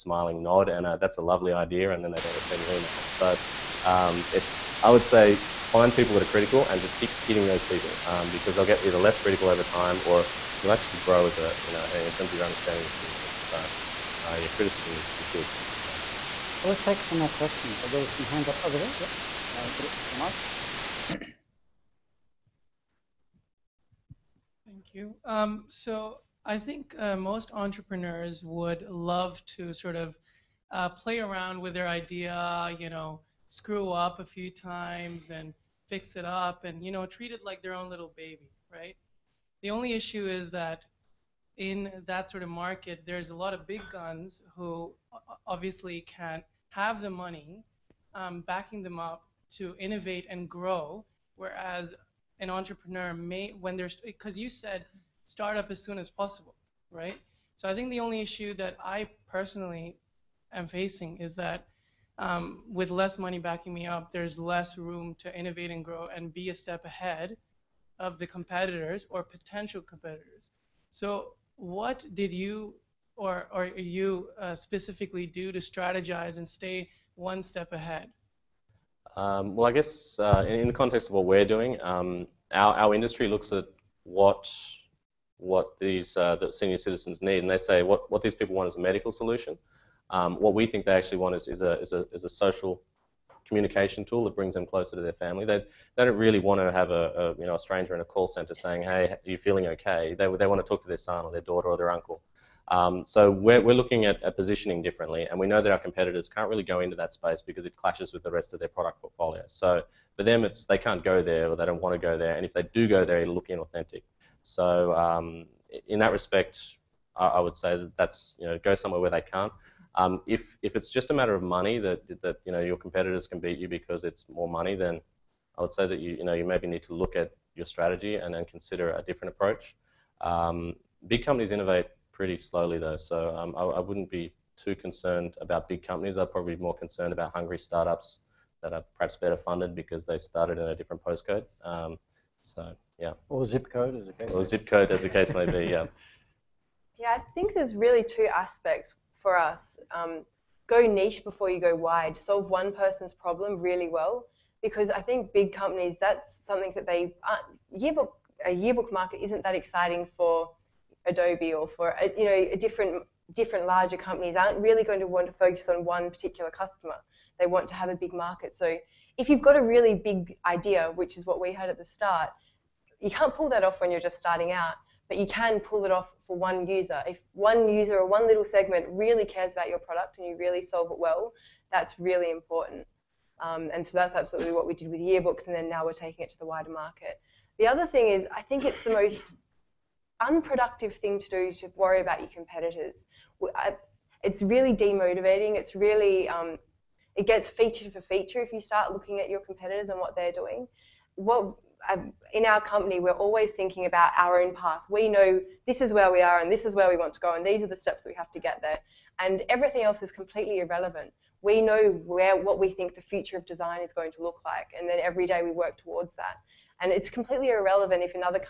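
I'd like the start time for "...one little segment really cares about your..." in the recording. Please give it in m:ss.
2:58.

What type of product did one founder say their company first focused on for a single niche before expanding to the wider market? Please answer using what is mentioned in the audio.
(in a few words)
yearbooks.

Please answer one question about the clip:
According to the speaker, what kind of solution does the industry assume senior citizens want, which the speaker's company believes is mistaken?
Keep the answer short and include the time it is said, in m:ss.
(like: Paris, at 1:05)
a medical solution, at 1:28.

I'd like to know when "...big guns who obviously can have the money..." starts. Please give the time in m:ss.
0:43.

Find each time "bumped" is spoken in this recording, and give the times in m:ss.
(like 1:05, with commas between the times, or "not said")
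not said.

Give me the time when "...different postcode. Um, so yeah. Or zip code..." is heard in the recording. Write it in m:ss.
2:20.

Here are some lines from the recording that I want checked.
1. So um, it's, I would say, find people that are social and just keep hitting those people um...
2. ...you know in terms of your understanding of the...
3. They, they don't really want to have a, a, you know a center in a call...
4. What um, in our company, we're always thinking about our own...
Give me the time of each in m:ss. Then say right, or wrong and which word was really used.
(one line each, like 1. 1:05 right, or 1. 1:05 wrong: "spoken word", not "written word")
1. 0:03 wrong: "critical", not "social"
2. 0:11 right
3. 1:35 wrong: "stranger", not "center"
4. 3:21 right.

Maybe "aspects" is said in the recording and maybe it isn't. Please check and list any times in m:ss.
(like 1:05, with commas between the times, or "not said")
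2:28.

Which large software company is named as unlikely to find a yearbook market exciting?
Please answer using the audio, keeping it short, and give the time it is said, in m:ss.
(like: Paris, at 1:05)
Adobe, at 2:41.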